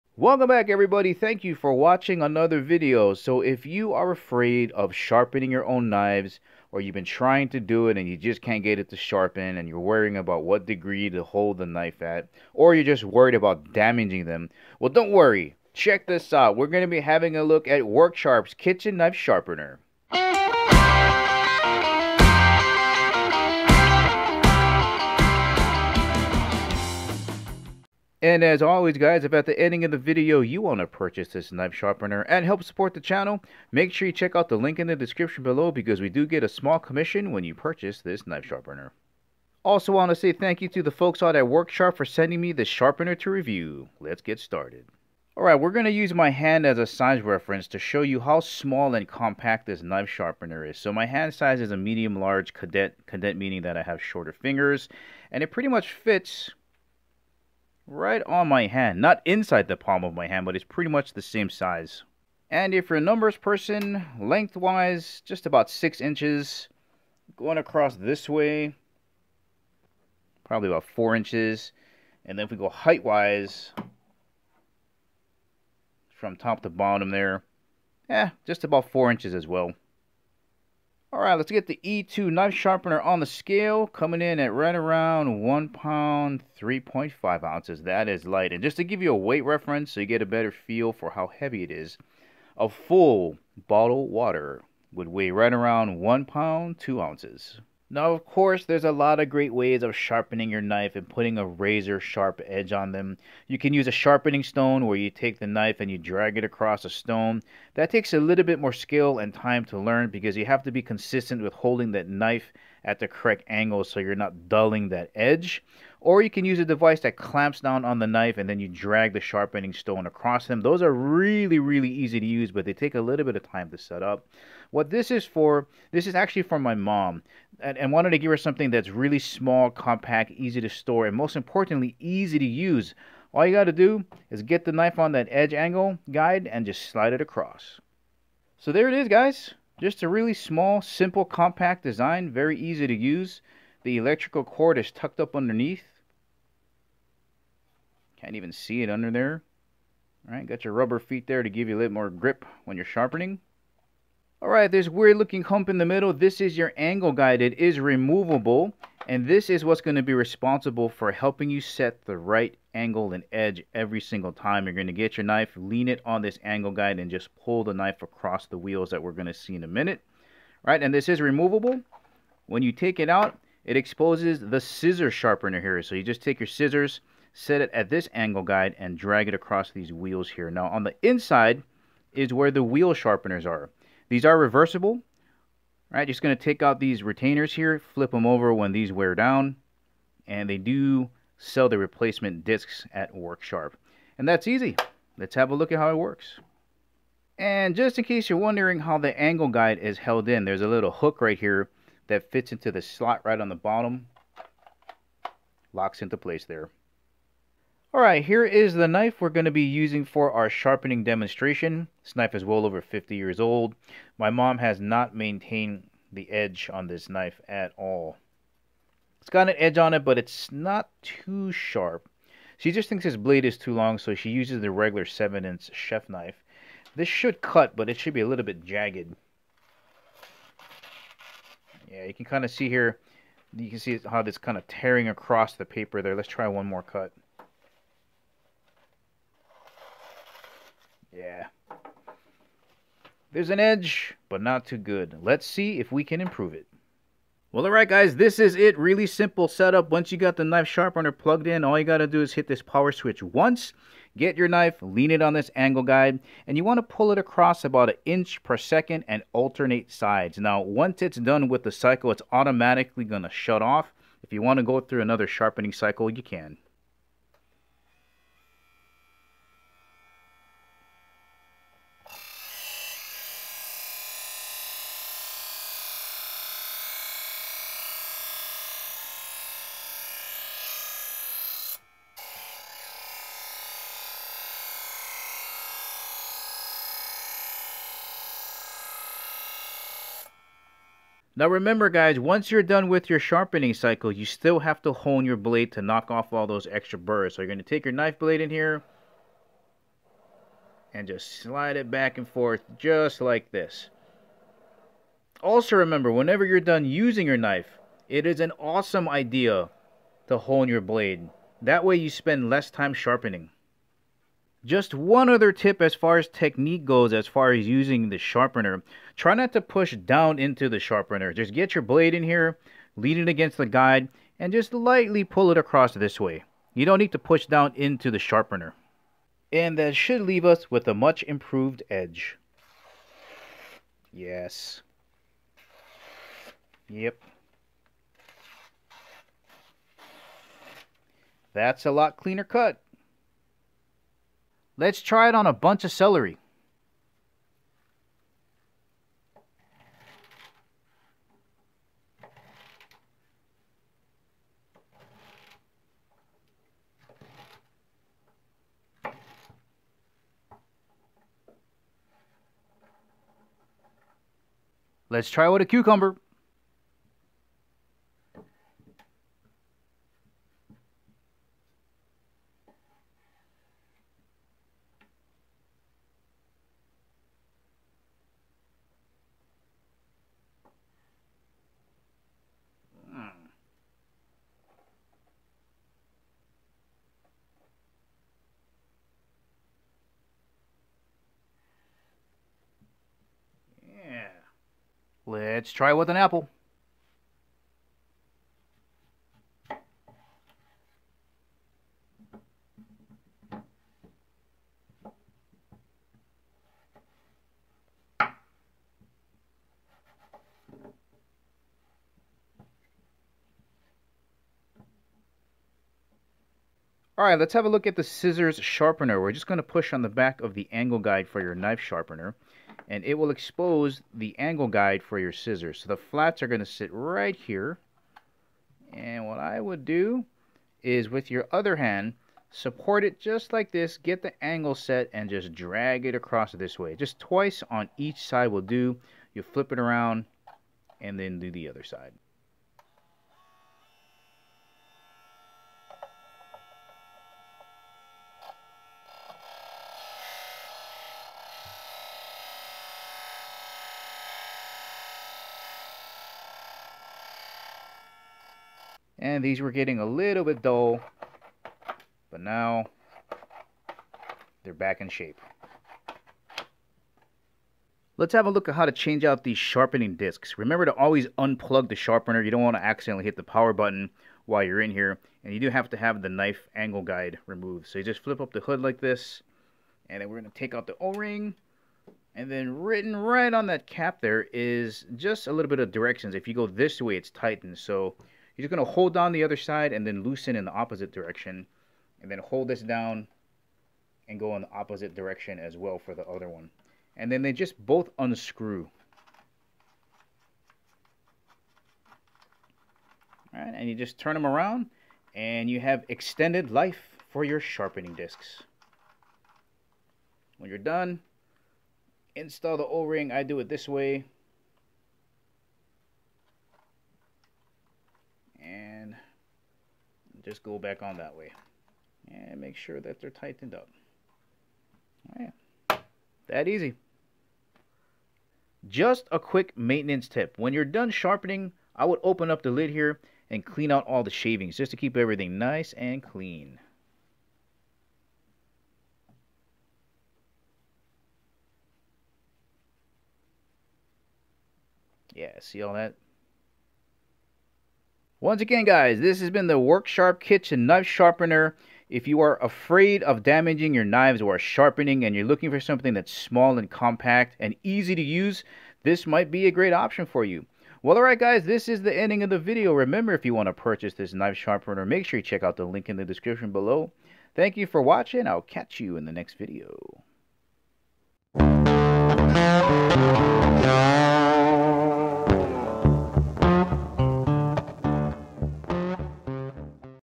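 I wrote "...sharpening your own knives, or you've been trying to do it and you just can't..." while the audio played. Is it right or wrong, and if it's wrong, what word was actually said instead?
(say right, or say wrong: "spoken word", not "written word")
right.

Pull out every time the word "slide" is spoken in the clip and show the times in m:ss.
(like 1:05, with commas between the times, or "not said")
2:16, 5:01.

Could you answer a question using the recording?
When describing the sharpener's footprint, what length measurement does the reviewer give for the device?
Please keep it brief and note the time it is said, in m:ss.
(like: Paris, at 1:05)
6 inches, at 1:05.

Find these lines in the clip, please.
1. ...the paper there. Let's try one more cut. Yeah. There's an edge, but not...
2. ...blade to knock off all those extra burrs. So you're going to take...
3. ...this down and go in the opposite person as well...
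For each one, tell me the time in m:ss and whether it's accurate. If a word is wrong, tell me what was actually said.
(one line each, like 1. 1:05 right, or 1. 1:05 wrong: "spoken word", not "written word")
1. 3:55 right
2. 4:55 right
3. 8:12 wrong: "direction", not "person".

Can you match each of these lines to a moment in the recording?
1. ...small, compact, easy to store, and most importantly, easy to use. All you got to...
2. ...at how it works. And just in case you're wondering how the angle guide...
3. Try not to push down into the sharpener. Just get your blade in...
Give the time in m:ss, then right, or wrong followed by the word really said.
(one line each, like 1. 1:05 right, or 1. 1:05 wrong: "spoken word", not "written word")
1. 2:09 right
2. 3:15 right
3. 5:19 right.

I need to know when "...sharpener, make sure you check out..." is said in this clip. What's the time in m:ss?
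9:24.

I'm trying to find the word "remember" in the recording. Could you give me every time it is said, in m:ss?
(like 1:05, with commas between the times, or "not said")
4:51, 5:05, 7:50, 9:22.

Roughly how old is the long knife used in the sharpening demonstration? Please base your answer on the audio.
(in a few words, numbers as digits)
Over 50 years.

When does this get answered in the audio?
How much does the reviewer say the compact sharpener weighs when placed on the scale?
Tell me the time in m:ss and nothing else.
1:25.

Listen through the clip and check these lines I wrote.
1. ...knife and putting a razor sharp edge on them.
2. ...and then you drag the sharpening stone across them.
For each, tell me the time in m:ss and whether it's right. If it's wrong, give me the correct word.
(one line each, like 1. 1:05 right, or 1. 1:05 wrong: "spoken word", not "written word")
1. 1:40 right
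2. 1:58 right.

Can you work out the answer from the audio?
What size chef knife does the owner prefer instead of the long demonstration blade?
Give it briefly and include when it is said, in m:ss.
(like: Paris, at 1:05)
7-inch, at 3:45.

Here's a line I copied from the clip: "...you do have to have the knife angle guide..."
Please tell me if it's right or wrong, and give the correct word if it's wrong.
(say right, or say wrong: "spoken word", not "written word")
right.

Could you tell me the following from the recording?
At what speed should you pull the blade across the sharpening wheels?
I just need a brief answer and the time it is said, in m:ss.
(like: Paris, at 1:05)
About an inch per second, at 4:17.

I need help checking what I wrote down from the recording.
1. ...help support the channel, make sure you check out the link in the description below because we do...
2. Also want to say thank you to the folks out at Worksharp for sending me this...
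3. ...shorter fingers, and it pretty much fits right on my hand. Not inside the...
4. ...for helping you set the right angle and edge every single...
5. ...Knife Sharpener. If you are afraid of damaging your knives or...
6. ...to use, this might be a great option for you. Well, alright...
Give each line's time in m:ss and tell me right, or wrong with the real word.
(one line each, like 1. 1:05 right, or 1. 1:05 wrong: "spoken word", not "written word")
1. 0:32 right
2. 0:39 right
3. 0:53 right
4. 2:40 right
5. 9:10 right
6. 9:18 right.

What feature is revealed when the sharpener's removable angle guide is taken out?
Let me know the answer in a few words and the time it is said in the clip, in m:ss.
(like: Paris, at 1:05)
Scissor sharpener, at 2:54.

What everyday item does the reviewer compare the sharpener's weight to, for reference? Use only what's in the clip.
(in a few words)
A full bottle of water.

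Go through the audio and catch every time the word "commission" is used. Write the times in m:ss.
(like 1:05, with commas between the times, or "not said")
0:36.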